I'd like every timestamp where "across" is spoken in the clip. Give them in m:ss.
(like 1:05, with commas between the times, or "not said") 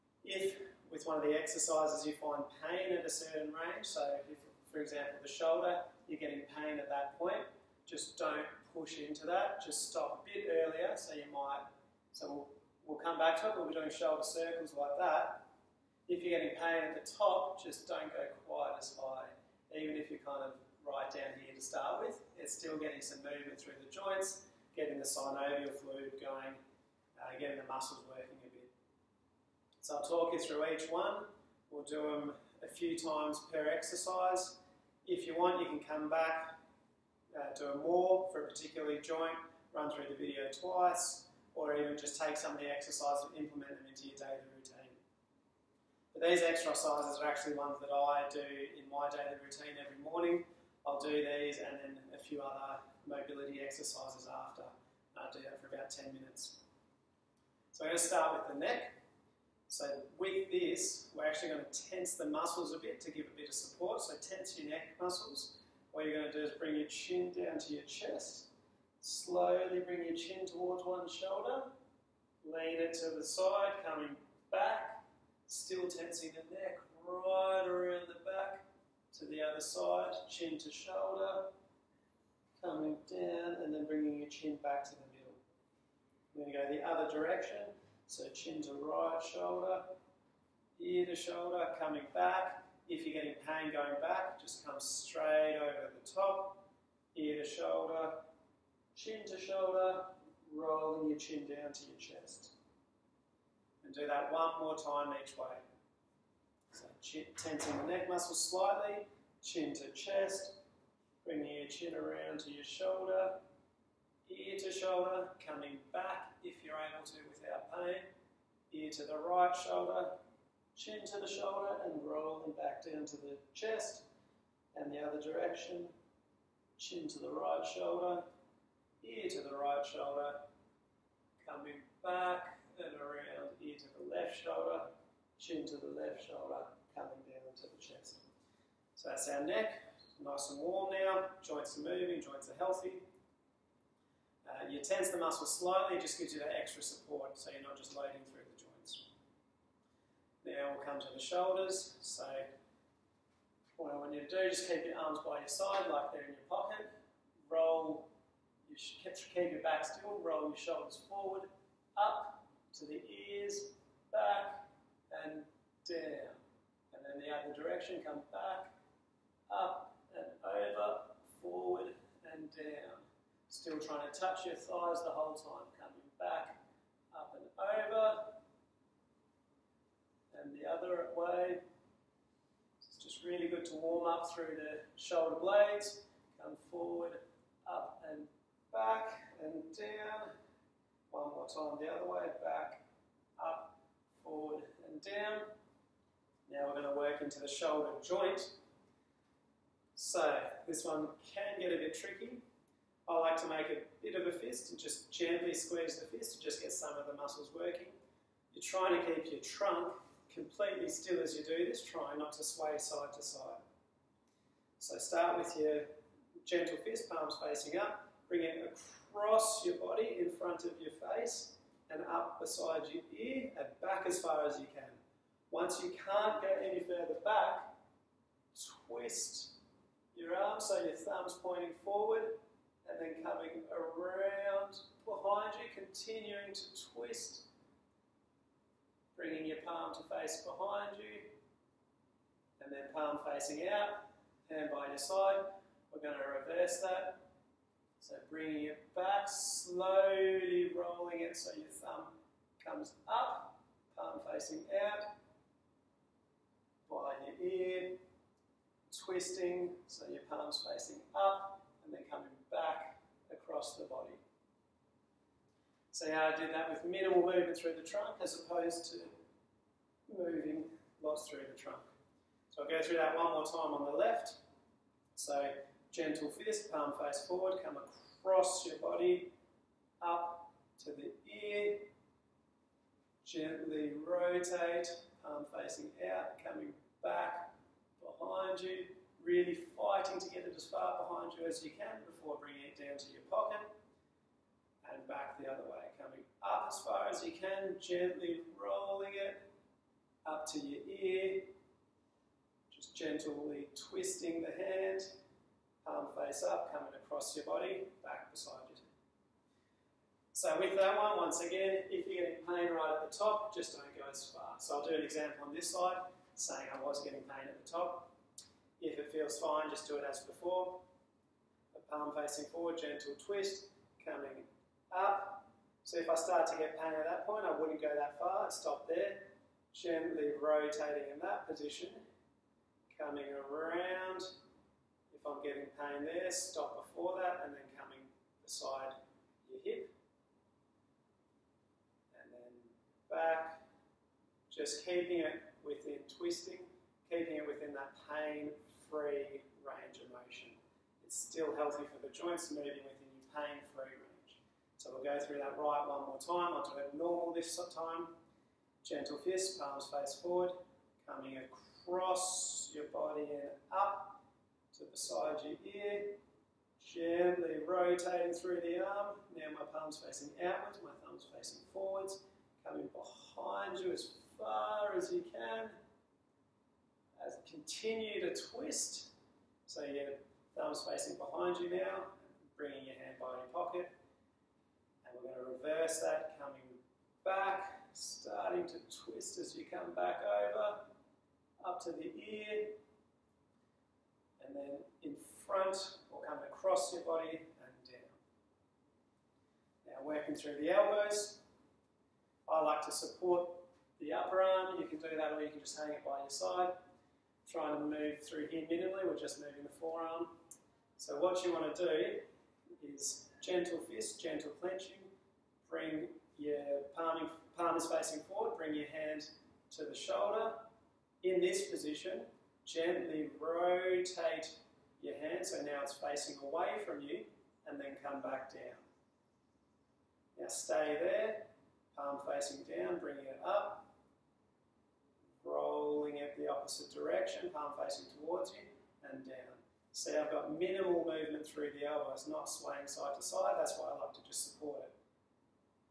3:39, 4:23, 4:37, 5:06, 6:01, 6:36.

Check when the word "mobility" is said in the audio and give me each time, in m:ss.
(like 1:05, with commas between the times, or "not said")
0:53.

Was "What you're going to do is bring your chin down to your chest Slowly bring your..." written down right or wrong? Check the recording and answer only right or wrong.
right.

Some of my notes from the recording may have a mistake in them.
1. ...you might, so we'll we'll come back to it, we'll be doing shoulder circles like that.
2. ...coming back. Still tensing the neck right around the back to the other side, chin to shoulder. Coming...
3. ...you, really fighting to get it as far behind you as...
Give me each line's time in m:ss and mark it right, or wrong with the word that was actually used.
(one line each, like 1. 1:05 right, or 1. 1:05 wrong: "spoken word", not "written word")
1. 0:11 right
2. 1:13 right
3. 4:48 right.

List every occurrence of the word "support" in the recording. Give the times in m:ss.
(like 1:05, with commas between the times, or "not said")
1:03, 2:26, 6:42, 7:24.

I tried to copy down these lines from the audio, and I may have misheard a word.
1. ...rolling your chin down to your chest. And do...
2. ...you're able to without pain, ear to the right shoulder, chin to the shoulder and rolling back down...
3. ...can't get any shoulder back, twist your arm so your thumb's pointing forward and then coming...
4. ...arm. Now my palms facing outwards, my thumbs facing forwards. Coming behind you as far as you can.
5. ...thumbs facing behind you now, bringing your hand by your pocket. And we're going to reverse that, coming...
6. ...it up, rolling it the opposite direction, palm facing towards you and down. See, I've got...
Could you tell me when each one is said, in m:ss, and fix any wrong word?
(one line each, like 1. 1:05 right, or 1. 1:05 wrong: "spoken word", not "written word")
1. 1:40 right
2. 1:56 right
3. 3:45 wrong: "further", not "shoulder"
4. 6:08 right
5. 6:20 right
6. 7:13 right.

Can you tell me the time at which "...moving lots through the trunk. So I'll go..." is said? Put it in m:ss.
4:30.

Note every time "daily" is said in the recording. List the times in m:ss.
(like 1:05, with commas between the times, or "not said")
0:44, 0:49.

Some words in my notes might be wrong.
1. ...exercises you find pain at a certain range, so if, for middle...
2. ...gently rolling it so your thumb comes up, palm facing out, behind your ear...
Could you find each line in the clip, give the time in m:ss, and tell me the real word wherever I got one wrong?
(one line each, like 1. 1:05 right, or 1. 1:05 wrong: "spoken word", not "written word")
1. 0:01 wrong: "example", not "middle"
2. 4:09 wrong: "slowly", not "gently".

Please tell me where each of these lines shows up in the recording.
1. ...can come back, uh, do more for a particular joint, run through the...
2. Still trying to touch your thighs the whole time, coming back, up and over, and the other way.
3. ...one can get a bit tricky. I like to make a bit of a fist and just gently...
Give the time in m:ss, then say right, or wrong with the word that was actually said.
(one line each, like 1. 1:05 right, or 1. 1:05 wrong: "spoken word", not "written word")
1. 0:35 right
2. 2:53 right
3. 3:20 right.